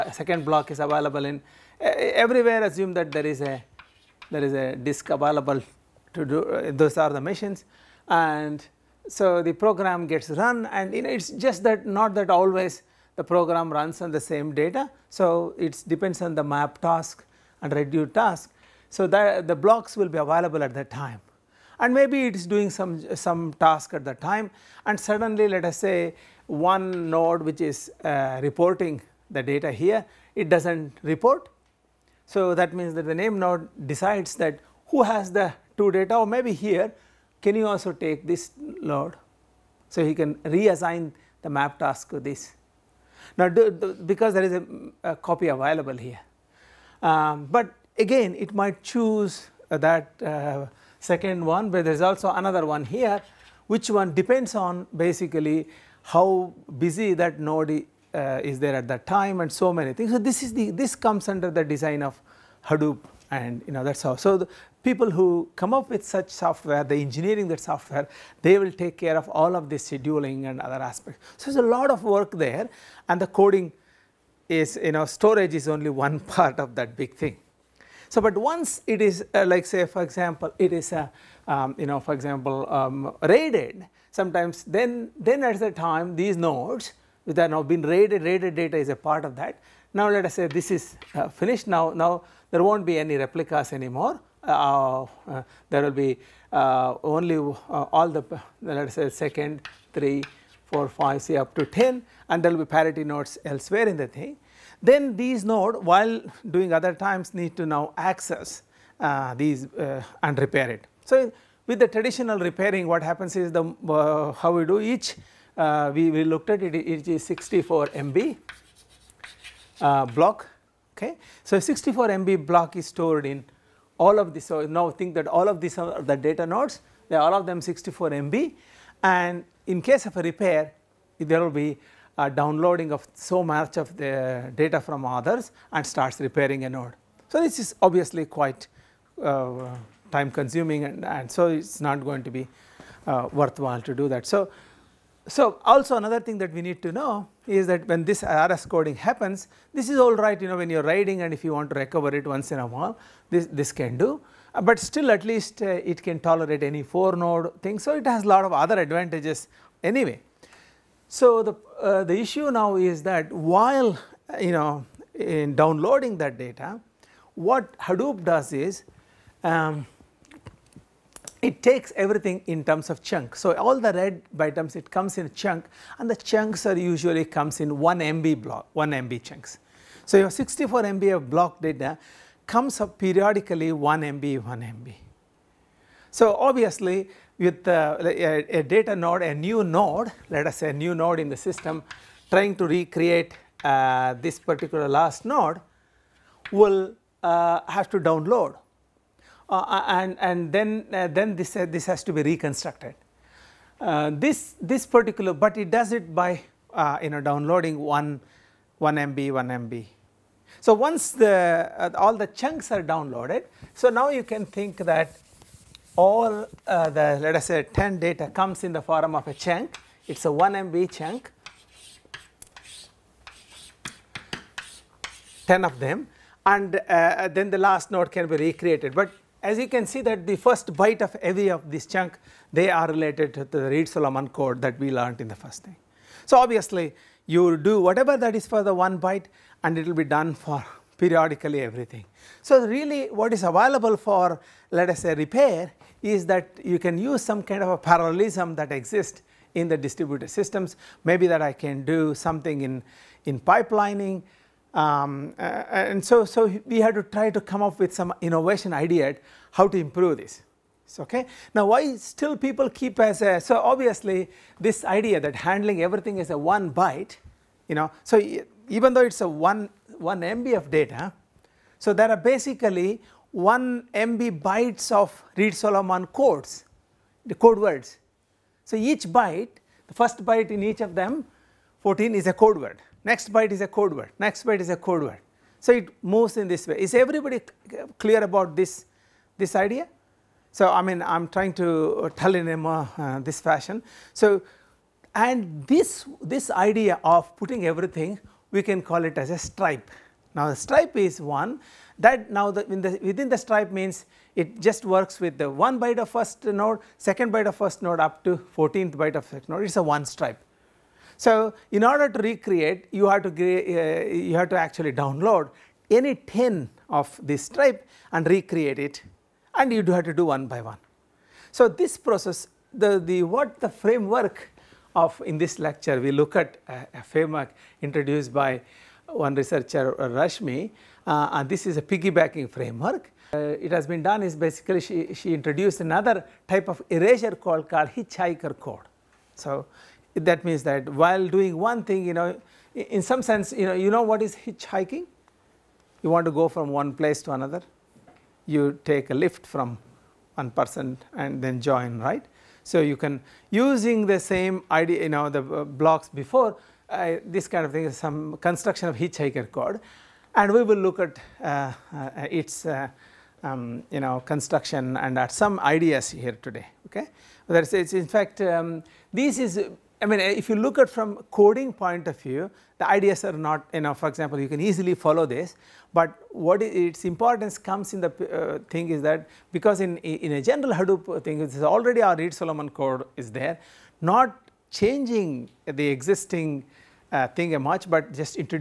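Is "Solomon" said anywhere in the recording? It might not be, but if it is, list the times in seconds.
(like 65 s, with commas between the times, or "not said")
233 s, 275 s, 382 s.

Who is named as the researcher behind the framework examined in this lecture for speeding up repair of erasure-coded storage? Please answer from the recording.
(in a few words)
Rashmi.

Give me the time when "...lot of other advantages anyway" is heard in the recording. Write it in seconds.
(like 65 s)
158 s.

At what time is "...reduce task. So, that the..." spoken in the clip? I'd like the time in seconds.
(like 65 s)
17 s.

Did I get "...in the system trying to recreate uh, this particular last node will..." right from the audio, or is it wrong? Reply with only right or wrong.
right.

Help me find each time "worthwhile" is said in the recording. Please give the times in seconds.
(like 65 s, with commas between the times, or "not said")
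143 s.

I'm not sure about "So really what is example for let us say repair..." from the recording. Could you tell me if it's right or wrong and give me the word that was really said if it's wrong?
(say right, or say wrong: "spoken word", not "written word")
wrong: "available", not "example".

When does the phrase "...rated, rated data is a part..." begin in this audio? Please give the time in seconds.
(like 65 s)
87 s.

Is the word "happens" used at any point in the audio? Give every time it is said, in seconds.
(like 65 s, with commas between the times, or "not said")
113 s, 148 s.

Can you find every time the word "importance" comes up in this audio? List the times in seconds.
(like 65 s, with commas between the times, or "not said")
377 s.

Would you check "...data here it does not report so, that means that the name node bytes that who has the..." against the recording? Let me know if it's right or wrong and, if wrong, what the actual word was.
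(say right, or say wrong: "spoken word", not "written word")
wrong: "decides", not "bytes".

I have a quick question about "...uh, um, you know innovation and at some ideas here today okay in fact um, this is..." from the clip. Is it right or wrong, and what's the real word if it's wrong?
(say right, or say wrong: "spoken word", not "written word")
wrong: "construction", not "innovation".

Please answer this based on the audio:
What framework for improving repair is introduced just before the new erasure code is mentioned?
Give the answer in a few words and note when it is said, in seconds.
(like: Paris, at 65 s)
piggybacking framework, at 331 s.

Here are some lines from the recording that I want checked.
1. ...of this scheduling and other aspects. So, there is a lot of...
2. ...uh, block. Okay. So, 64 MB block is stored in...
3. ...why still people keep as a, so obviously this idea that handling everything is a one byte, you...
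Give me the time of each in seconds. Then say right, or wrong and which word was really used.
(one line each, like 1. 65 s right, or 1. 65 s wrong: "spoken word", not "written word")
1. 69 s right
2. 119 s right
3. 261 s right.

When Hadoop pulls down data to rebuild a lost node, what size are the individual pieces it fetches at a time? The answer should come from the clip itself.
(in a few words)
1 MB.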